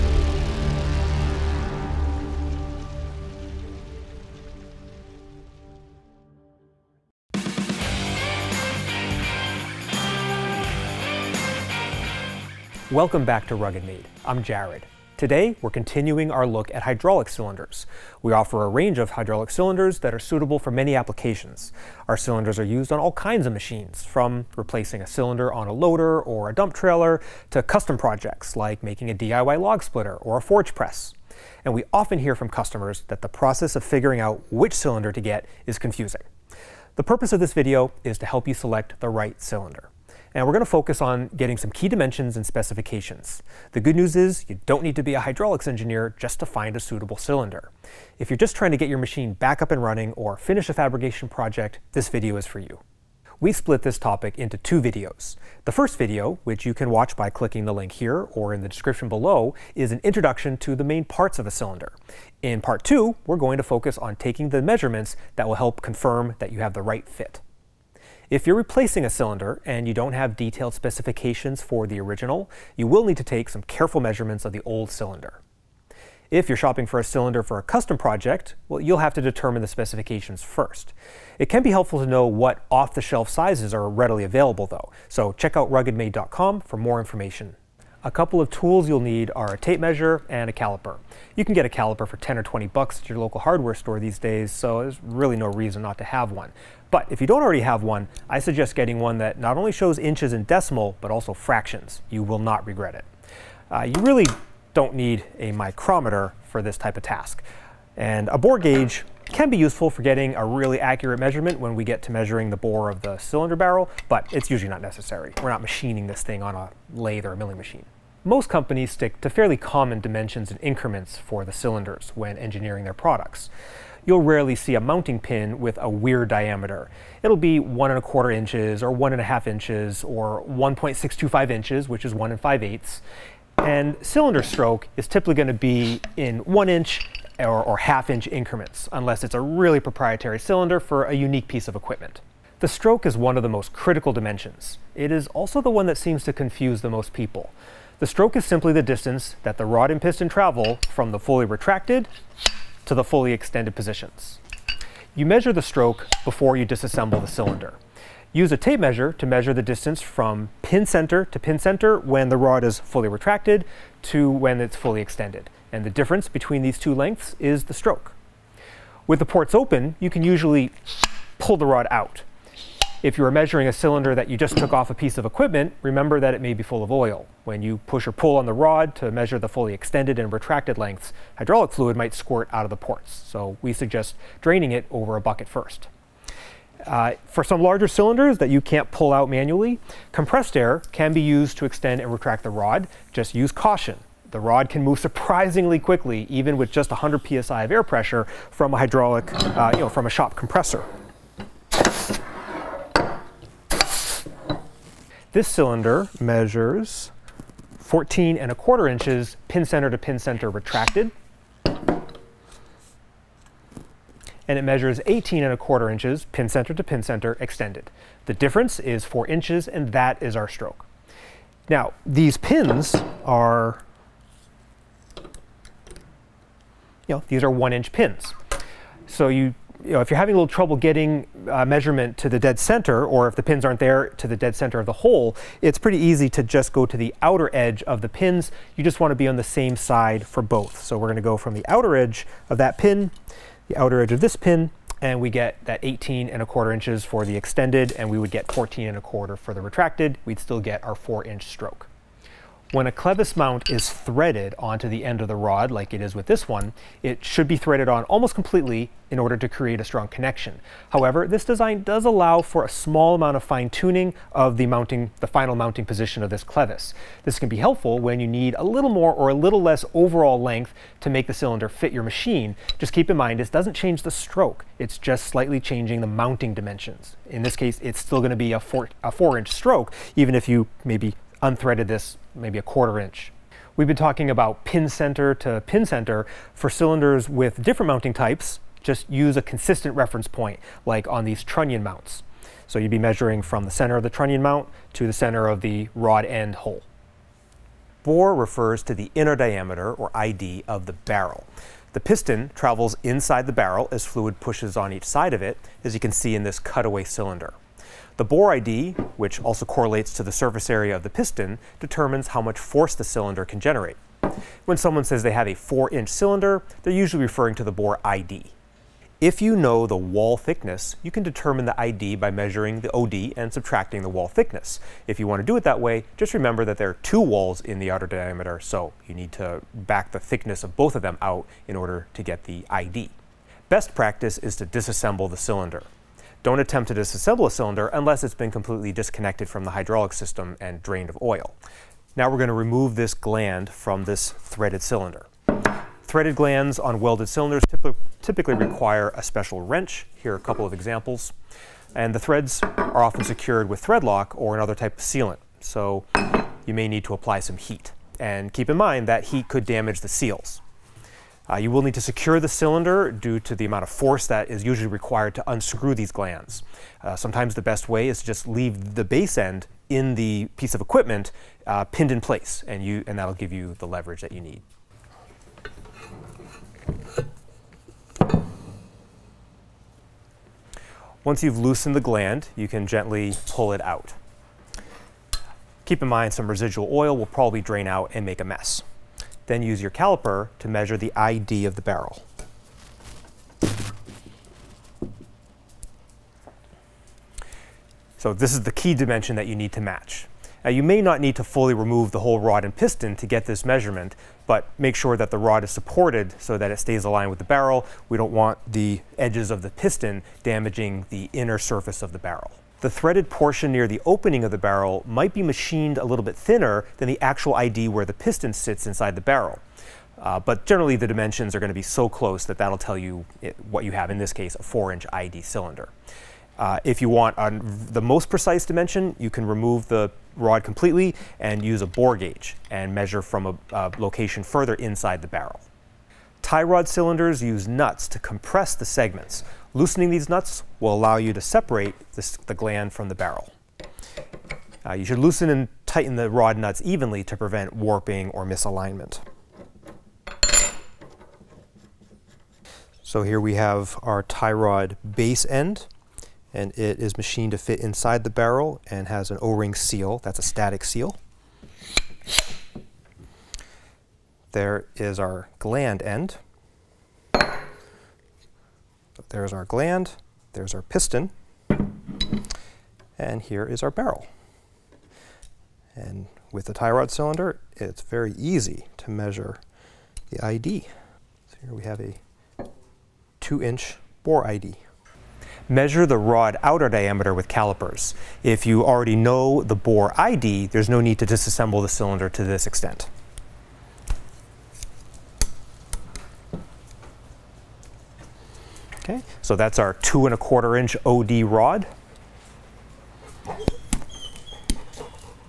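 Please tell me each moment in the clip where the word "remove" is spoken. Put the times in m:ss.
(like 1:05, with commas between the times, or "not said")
5:42, 6:41, 7:09.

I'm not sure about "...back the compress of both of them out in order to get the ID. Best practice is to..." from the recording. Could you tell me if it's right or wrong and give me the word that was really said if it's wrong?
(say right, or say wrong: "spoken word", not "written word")
wrong: "thickness", not "compress".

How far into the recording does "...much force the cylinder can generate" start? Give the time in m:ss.
5:12.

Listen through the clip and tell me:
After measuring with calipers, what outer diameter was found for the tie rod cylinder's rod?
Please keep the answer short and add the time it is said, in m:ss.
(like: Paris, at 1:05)
2 1/4 inch, at 8:19.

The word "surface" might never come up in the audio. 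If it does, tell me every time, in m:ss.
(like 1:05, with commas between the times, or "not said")
5:10, 6:51.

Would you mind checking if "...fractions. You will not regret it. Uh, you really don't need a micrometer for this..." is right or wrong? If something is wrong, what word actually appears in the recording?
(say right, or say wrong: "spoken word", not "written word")
right.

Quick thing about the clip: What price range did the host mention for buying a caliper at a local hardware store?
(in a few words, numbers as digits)
10 or 20 bucks.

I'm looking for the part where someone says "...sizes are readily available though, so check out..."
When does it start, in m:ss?
1:23.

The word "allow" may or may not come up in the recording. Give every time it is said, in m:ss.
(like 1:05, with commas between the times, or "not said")
4:22, 7:20.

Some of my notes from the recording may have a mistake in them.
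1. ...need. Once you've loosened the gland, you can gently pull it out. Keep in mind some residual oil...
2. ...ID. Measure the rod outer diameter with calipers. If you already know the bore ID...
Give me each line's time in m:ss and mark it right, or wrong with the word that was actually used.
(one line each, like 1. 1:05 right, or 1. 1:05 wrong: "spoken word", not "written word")
1. 6:14 right
2. 8:04 right.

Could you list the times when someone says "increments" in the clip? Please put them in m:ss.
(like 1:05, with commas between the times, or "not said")
2:00, 2:18.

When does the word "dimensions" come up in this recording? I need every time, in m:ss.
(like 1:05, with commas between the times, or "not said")
0:41, 2:00, 2:24, 4:36, 6:38, 7:01, 7:08.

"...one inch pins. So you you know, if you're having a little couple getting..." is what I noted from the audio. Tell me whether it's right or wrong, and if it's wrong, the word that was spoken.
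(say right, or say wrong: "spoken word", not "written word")
wrong: "trouble", not "couple".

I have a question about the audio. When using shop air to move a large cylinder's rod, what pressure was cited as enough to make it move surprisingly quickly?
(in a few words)
100 psi.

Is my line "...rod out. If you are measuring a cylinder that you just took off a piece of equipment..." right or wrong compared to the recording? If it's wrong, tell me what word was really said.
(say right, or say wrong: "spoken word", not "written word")
right.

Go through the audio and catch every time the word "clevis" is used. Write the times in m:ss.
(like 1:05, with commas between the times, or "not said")
4:12, 4:26.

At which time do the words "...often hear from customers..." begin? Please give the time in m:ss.
0:31.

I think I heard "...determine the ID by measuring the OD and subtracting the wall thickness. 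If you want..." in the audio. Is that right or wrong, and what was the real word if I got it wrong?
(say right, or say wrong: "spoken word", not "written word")
right.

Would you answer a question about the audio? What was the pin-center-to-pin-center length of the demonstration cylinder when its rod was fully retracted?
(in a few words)
14 1/4 inches.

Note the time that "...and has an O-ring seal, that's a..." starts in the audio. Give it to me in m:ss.
7:38.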